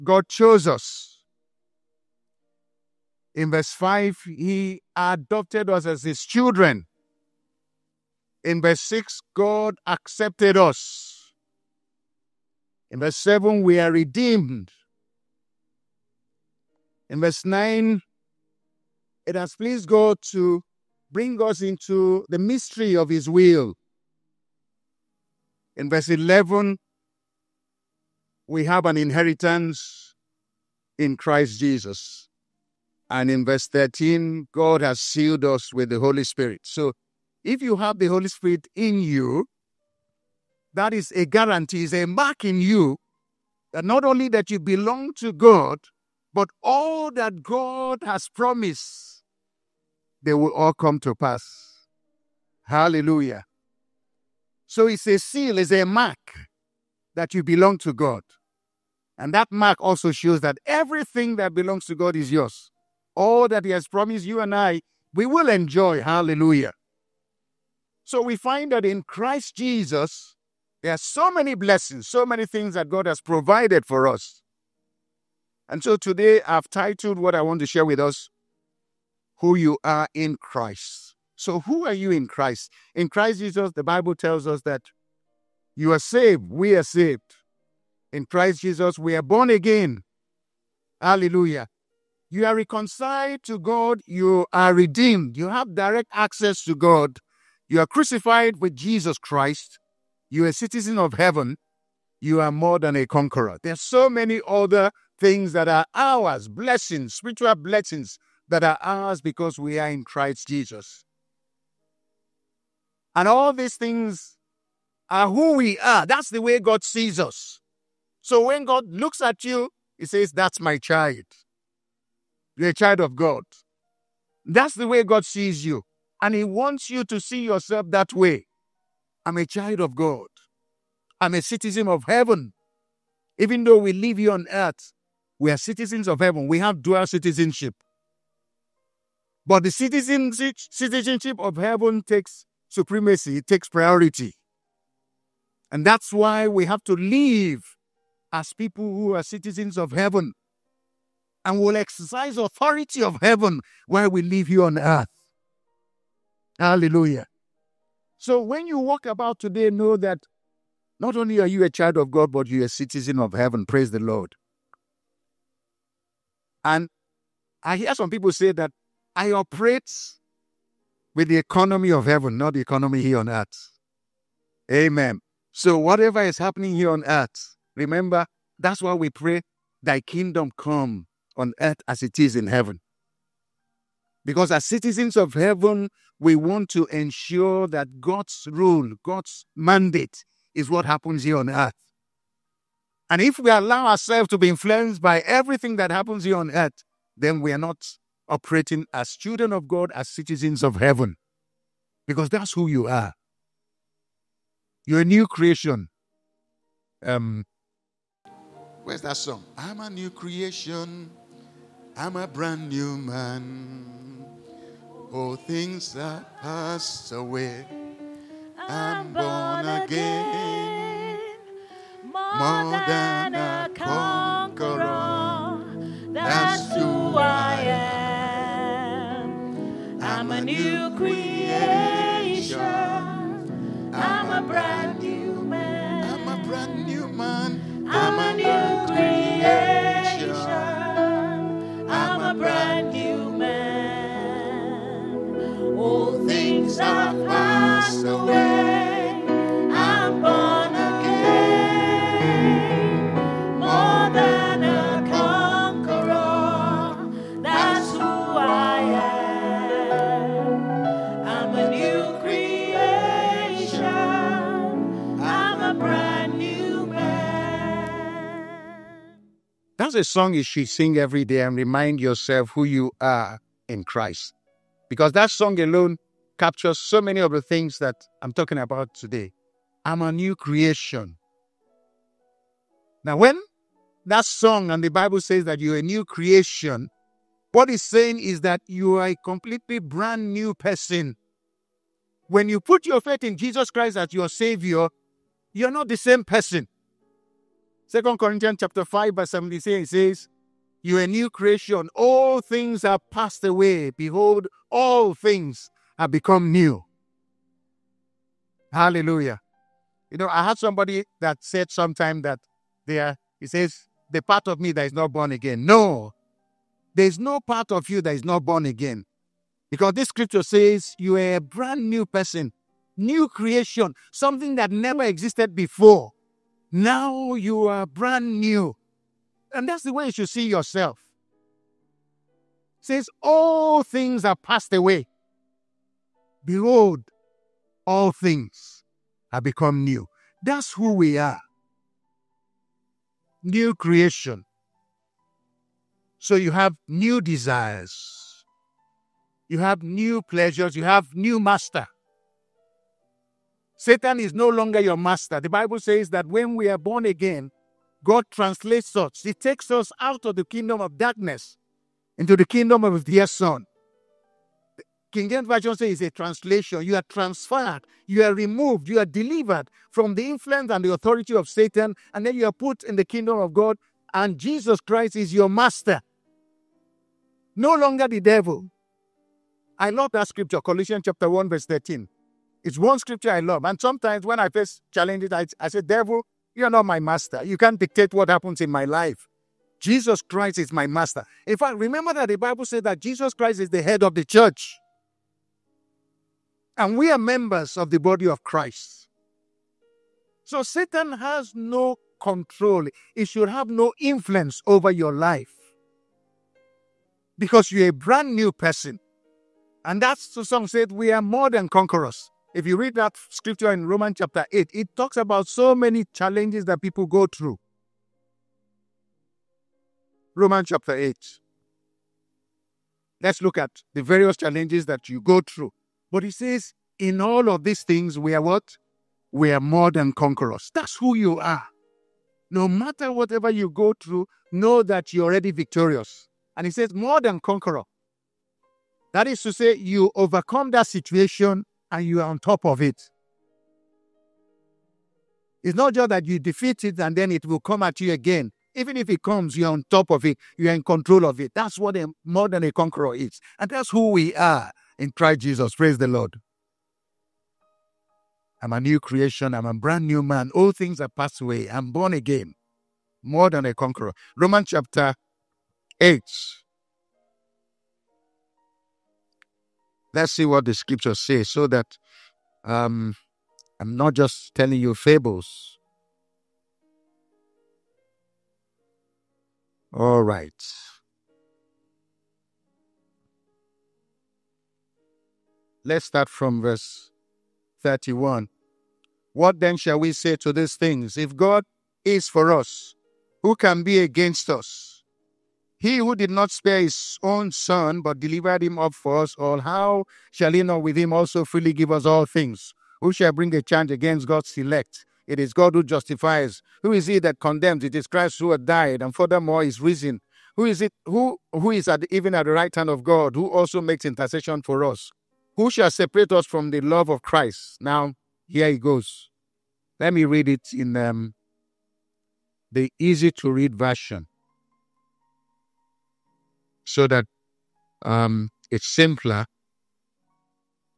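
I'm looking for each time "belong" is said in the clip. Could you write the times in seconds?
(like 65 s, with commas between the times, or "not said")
44 s, 57 s, 61 s.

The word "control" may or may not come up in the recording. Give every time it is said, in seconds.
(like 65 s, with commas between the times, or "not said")
402 s, 450 s.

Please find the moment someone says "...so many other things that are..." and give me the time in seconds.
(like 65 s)
103 s.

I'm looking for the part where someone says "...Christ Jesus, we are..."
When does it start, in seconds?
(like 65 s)
88 s.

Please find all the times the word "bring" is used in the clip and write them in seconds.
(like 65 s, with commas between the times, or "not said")
21 s, 503 s.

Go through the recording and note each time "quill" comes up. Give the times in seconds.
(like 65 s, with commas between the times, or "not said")
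not said.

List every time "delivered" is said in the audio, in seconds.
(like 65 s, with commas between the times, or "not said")
369 s, 498 s.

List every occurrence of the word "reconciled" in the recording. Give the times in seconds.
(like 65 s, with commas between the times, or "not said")
92 s.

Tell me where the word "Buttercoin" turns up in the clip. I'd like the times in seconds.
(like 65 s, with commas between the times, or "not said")
not said.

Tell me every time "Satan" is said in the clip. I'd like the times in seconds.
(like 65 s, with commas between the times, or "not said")
353 s, 371 s, 400 s.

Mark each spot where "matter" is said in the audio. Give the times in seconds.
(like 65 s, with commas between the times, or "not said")
432 s.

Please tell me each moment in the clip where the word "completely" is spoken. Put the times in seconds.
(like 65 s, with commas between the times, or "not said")
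289 s.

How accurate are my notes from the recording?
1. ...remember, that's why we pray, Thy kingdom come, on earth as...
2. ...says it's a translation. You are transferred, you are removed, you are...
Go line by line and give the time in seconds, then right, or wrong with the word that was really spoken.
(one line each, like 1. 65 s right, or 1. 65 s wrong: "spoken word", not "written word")
1. 177 s right
2. 365 s right.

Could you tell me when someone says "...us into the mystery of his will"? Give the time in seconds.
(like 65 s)
21 s.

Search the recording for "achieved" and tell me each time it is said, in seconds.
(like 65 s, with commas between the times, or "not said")
not said.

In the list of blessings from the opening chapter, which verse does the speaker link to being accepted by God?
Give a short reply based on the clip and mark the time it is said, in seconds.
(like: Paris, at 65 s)
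Verse 6, at 8 s.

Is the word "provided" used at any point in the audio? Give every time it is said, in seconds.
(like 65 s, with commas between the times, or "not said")
73 s.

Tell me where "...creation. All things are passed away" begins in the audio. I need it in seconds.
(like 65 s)
301 s.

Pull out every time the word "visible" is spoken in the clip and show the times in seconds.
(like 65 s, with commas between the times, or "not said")
not said.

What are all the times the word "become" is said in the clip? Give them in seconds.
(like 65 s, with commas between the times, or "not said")
306 s, 339 s.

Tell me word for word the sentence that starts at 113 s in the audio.
And all these things are who we are.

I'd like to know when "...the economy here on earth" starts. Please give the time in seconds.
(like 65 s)
172 s.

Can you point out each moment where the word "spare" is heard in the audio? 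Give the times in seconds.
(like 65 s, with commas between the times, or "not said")
496 s.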